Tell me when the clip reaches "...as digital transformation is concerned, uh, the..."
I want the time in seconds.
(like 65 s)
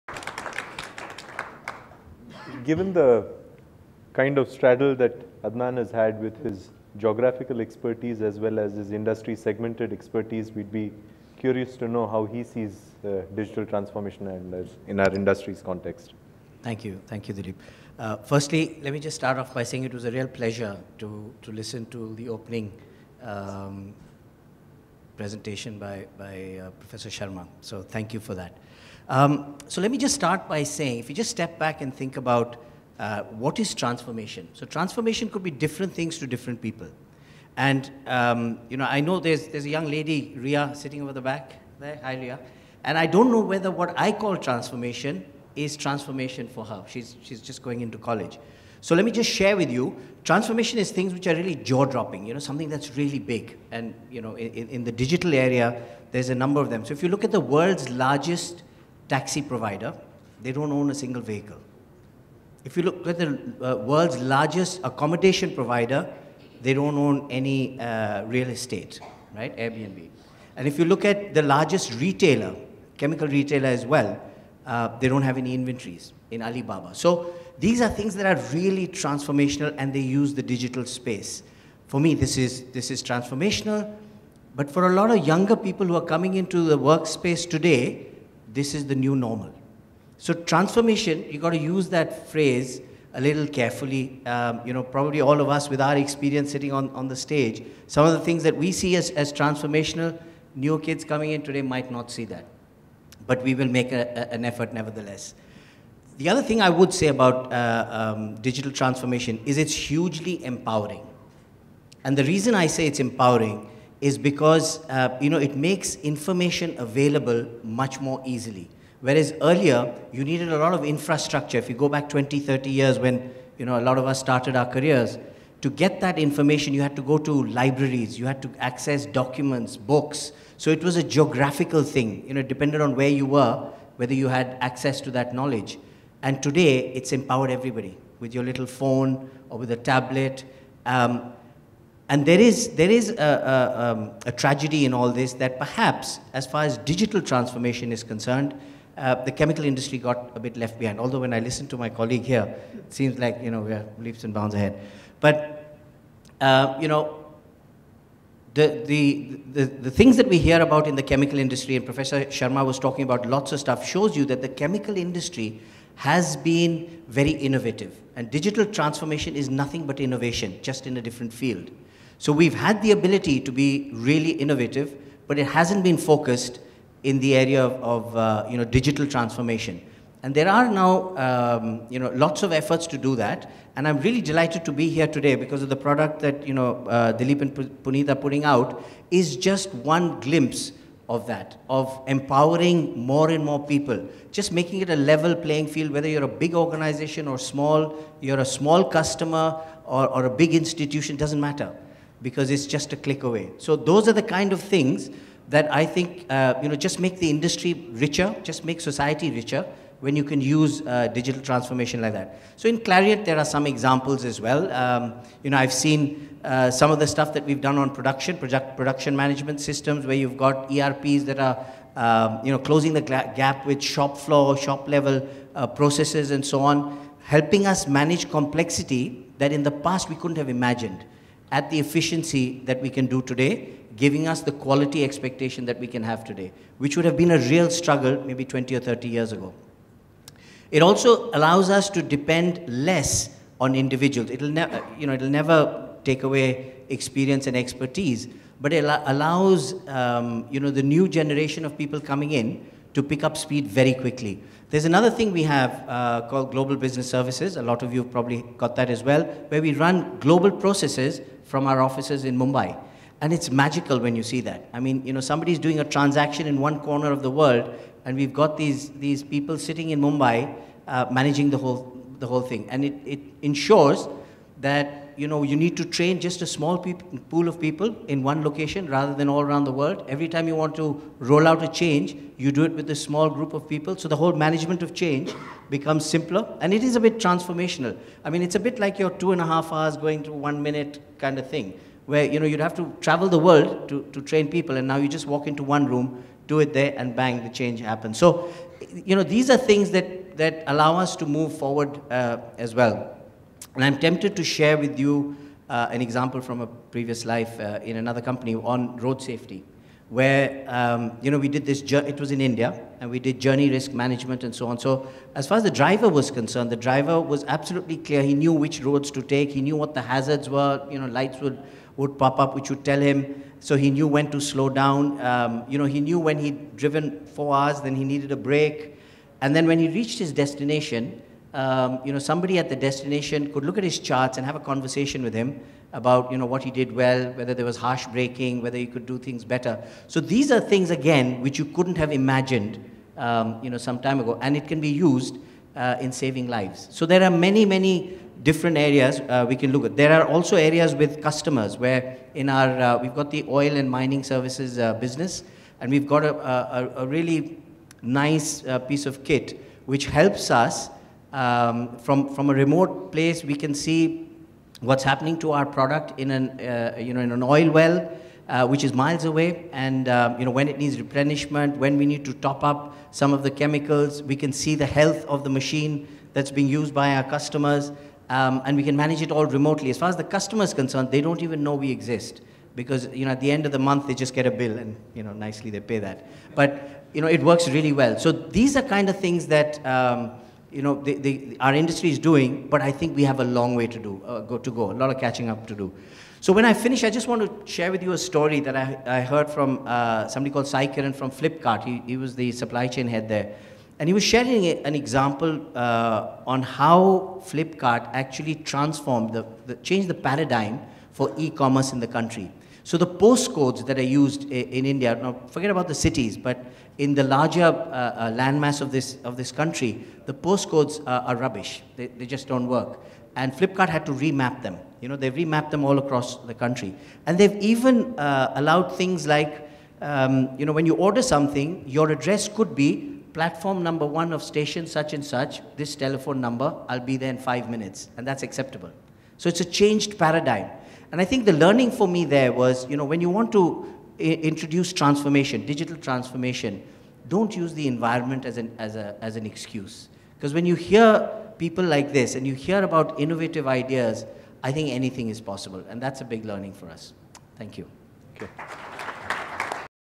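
146 s.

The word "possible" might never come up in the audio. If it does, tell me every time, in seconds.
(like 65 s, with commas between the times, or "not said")
455 s.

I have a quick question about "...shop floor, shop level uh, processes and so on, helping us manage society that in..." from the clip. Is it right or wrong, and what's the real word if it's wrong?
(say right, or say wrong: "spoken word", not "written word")
wrong: "complexity", not "society".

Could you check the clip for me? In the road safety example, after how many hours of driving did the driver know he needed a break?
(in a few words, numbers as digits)
4 hours.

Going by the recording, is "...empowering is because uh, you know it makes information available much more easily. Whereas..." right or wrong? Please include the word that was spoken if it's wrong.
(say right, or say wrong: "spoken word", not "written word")
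right.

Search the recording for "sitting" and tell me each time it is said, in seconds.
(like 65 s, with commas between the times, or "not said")
40 s, 96 s, 269 s.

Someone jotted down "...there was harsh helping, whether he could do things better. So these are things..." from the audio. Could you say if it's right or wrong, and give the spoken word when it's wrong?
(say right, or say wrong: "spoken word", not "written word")
wrong: "braking", not "helping".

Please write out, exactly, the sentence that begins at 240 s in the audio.
It also allows us to depend less on individuals.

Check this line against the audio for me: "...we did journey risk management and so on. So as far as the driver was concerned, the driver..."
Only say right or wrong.
right.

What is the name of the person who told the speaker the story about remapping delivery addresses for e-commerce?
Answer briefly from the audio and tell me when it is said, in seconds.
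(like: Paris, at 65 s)
Sai Kiran, at 400 s.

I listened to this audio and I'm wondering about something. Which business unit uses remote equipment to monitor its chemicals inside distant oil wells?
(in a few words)
Oil and mining services.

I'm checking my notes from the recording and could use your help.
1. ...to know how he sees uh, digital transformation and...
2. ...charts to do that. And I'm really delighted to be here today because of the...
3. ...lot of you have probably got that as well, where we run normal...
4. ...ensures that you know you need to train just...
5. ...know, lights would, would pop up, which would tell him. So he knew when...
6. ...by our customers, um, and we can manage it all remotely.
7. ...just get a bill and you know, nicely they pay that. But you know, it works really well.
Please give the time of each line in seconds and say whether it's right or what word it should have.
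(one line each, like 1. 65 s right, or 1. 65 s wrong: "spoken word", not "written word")
1. 11 s right
2. 182 s wrong: "efforts", not "charts"
3. 257 s wrong: "global", not "normal"
4. 273 s right
5. 320 s right
6. 376 s right
7. 384 s right.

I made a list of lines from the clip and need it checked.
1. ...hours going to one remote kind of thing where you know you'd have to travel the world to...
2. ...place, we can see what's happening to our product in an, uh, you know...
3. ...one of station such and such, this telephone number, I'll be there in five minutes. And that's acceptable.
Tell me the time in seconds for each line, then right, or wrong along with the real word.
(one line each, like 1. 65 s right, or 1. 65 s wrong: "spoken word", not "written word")
1. 289 s wrong: "minute", not "remote"
2. 363 s right
3. 434 s right.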